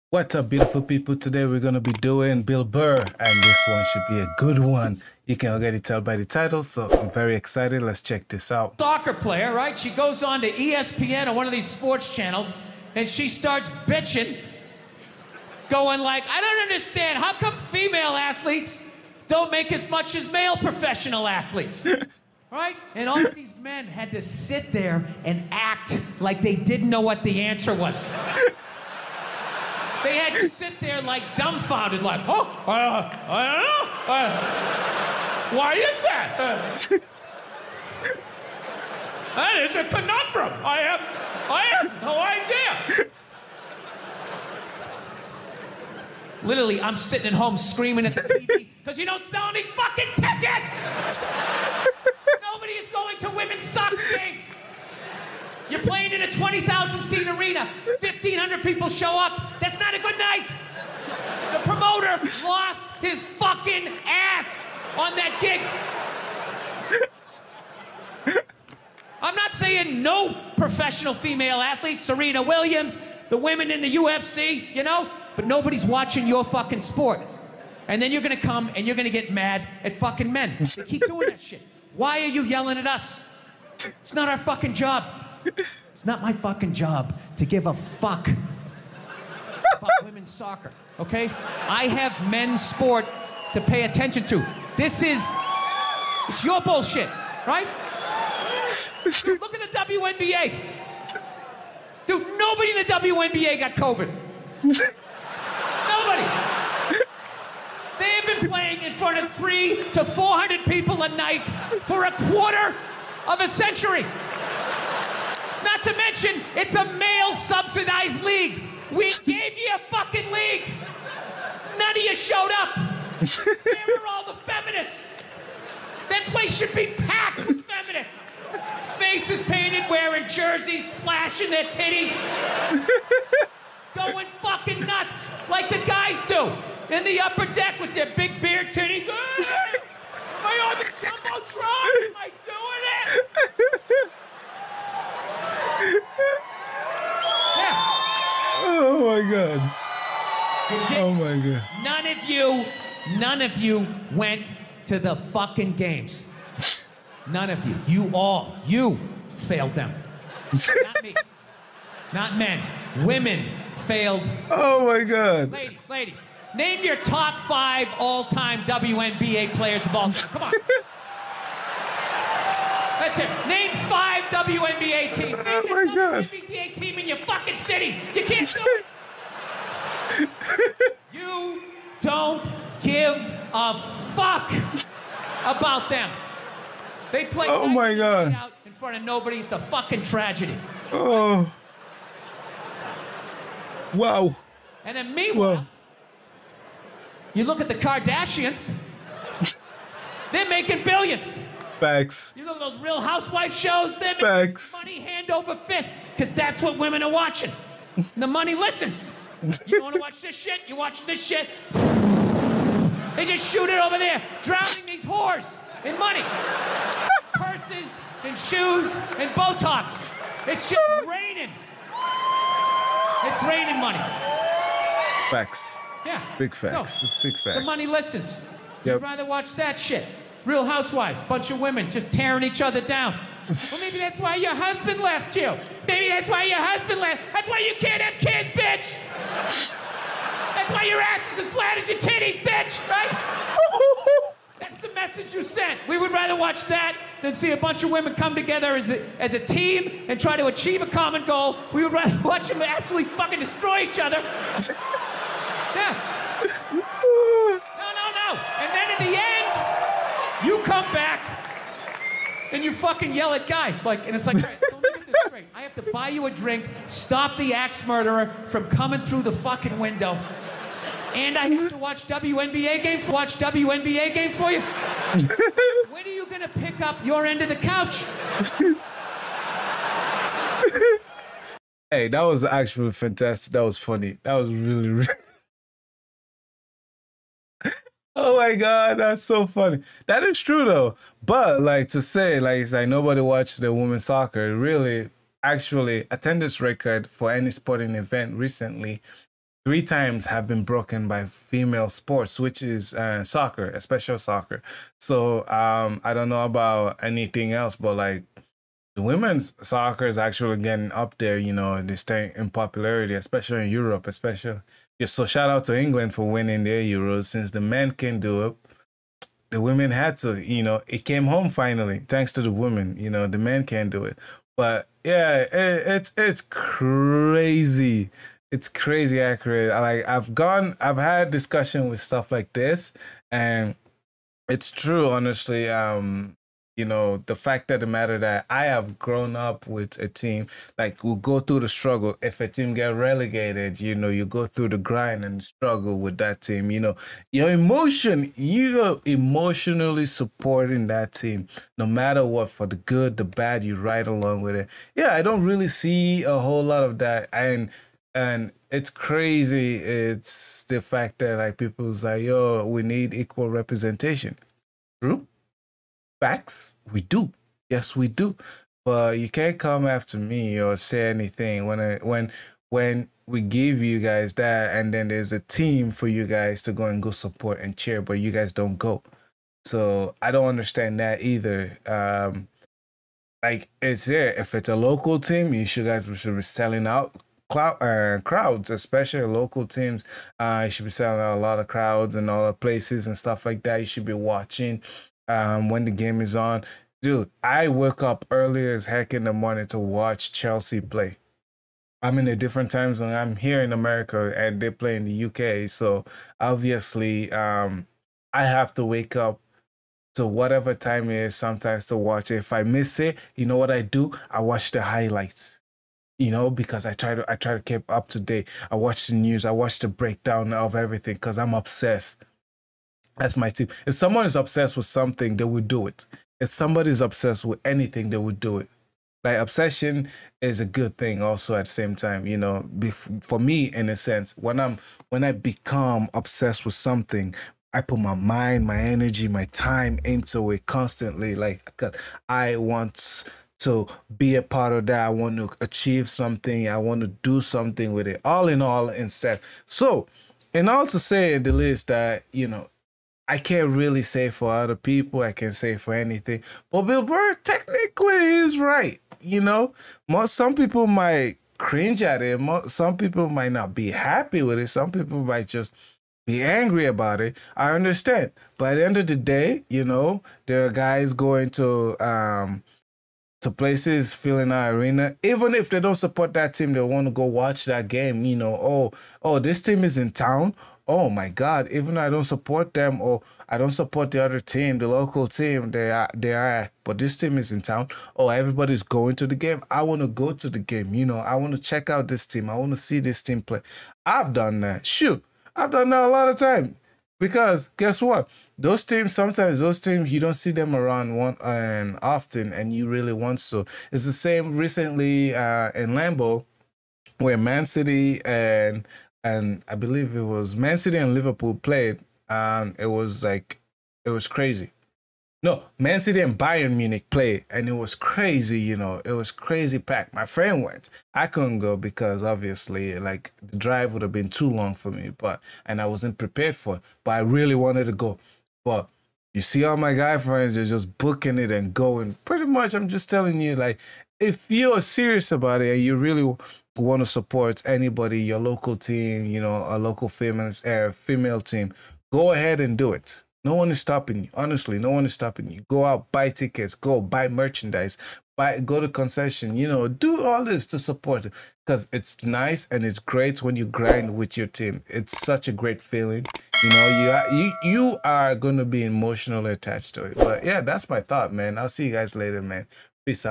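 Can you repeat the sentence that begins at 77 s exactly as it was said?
And then you're gonna come and you're gonna get mad at fucking men.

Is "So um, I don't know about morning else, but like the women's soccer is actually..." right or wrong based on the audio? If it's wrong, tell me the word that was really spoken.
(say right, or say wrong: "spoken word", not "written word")
wrong: "anything", not "morning".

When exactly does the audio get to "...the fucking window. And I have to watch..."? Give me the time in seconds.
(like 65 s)
269 s.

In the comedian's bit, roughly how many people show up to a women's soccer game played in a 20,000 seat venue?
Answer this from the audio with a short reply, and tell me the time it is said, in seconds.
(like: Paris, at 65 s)
1,500, at 58 s.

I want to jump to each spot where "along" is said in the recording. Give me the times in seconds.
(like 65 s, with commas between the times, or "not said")
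354 s.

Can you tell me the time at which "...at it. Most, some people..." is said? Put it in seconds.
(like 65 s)
462 s.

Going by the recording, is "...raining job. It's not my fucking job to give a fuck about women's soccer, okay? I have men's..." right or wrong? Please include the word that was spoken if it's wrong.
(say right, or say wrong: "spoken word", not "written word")
wrong: "fucking", not "raining".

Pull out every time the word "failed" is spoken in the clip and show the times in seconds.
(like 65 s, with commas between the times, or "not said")
159 s, 163 s.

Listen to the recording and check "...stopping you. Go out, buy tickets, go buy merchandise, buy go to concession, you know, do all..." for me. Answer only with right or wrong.
right.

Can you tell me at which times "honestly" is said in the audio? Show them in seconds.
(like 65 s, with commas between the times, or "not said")
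335 s, 544 s.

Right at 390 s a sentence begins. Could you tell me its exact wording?
Uh, you should be selling out a lot of crowds and all the places and stuff like that.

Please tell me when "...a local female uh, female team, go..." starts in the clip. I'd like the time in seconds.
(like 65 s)
539 s.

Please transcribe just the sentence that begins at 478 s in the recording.
You know, oh, oh, this team is in town.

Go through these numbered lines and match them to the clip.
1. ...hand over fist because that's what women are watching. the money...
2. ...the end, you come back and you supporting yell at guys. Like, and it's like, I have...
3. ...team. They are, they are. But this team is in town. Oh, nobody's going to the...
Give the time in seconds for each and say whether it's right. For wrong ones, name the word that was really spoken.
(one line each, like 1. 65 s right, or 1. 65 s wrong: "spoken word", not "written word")
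1. 205 s right
2. 259 s wrong: "fucking", not "supporting"
3. 485 s wrong: "everybody", not "nobody".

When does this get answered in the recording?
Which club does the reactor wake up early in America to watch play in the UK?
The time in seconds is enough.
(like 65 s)
400 s.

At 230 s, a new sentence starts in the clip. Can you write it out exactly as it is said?
Real Housewives, bunch of women just tearing each other down.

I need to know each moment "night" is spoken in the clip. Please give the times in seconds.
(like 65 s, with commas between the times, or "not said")
60 s, 111 s.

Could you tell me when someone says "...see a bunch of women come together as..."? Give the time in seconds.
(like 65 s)
247 s.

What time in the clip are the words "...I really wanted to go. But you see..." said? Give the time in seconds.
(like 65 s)
527 s.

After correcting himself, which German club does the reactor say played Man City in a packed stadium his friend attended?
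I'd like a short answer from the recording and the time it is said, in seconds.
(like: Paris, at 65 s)
Bayern Munich, at 516 s.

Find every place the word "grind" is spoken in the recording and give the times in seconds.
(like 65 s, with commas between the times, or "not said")
344 s, 553 s.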